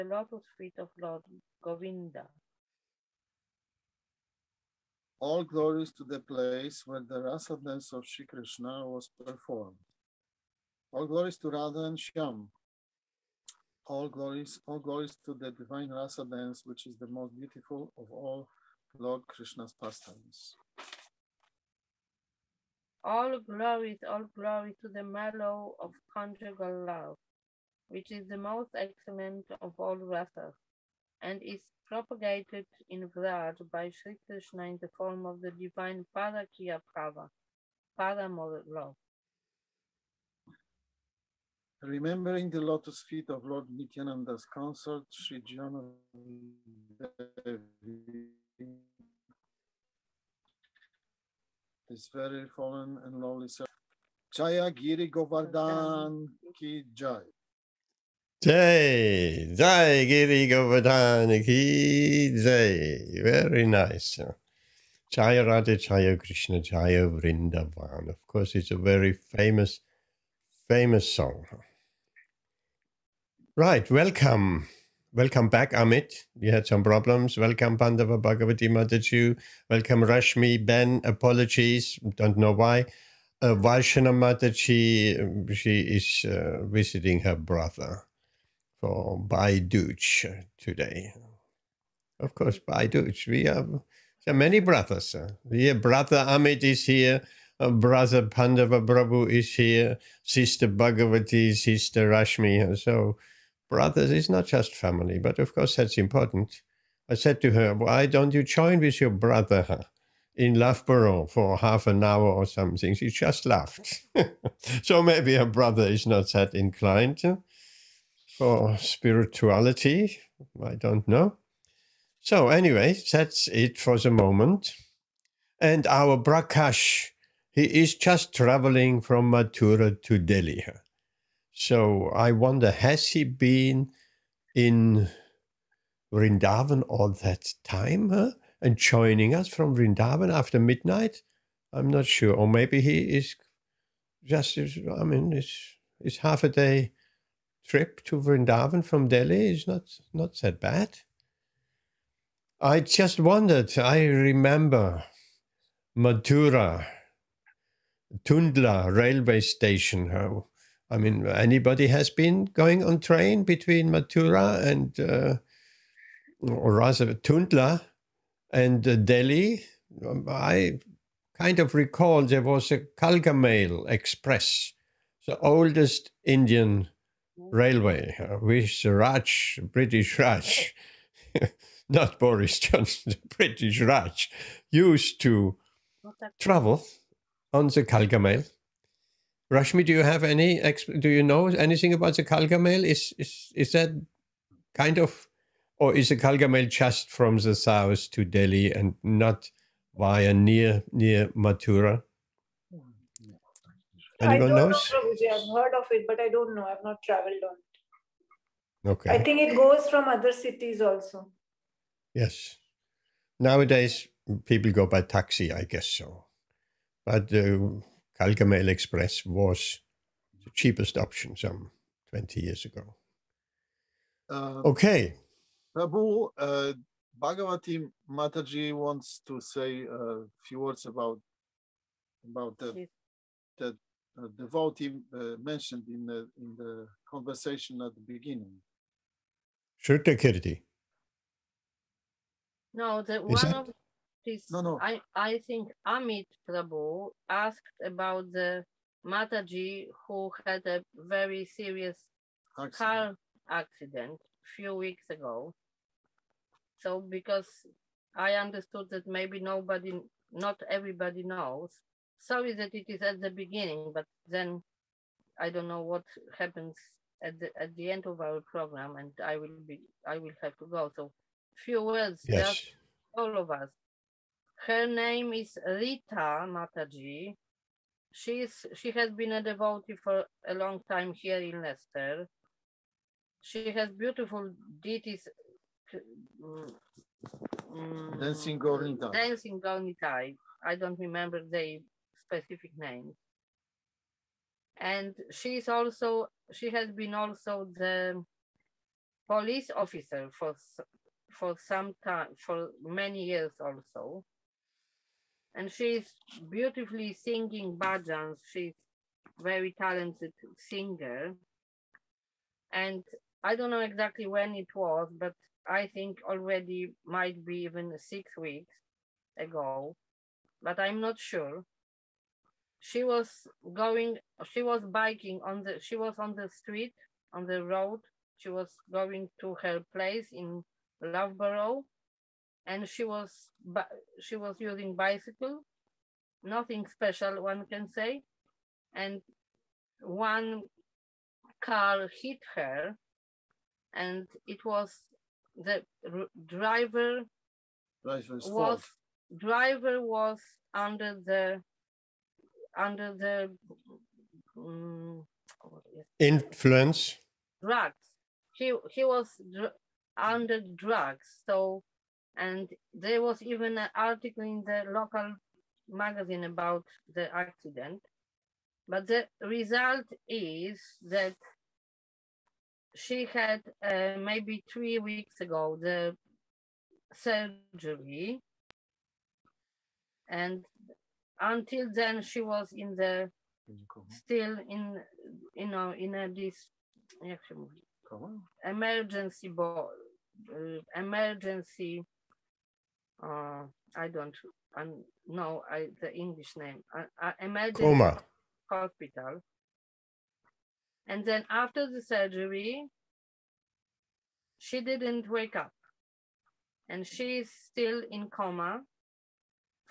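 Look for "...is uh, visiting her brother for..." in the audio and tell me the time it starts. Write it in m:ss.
1:25.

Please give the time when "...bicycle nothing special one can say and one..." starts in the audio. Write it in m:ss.
5:34.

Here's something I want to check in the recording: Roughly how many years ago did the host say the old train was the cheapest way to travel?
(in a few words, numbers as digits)
20 years.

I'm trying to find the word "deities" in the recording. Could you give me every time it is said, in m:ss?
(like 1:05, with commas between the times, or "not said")
4:44.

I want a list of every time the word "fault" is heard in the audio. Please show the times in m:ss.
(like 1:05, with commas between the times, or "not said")
5:48.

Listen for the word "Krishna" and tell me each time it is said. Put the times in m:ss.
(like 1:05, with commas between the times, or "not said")
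0:08, 0:19, 0:34, 1:06.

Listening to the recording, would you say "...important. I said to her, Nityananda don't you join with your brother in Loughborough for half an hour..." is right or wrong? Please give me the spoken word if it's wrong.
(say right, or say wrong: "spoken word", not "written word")
wrong: "Why", not "Nityananda".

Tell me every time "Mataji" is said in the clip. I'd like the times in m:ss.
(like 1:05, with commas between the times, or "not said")
1:18, 1:23, 3:48, 4:09, 4:36.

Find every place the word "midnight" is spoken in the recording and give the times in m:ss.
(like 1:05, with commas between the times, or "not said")
2:20.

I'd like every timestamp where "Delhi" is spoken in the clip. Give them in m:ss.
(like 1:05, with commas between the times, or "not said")
2:10, 2:29, 2:48, 3:18.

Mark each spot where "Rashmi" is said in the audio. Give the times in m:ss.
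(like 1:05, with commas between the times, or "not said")
1:20, 1:42, 3:09.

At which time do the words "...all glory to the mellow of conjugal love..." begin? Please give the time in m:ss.
0:24.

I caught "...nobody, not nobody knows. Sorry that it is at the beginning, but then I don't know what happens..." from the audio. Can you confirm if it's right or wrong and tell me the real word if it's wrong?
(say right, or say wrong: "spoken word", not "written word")
wrong: "everybody", not "nobody".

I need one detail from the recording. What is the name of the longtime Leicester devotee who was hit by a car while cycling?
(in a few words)
Rita.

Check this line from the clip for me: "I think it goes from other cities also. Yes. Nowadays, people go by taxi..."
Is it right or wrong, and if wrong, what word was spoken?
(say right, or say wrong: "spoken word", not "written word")
right.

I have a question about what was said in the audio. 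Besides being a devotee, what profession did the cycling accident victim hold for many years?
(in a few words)
police officer.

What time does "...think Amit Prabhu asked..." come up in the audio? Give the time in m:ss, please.
4:05.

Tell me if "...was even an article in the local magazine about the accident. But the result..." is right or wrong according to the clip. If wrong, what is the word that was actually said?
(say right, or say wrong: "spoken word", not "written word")
right.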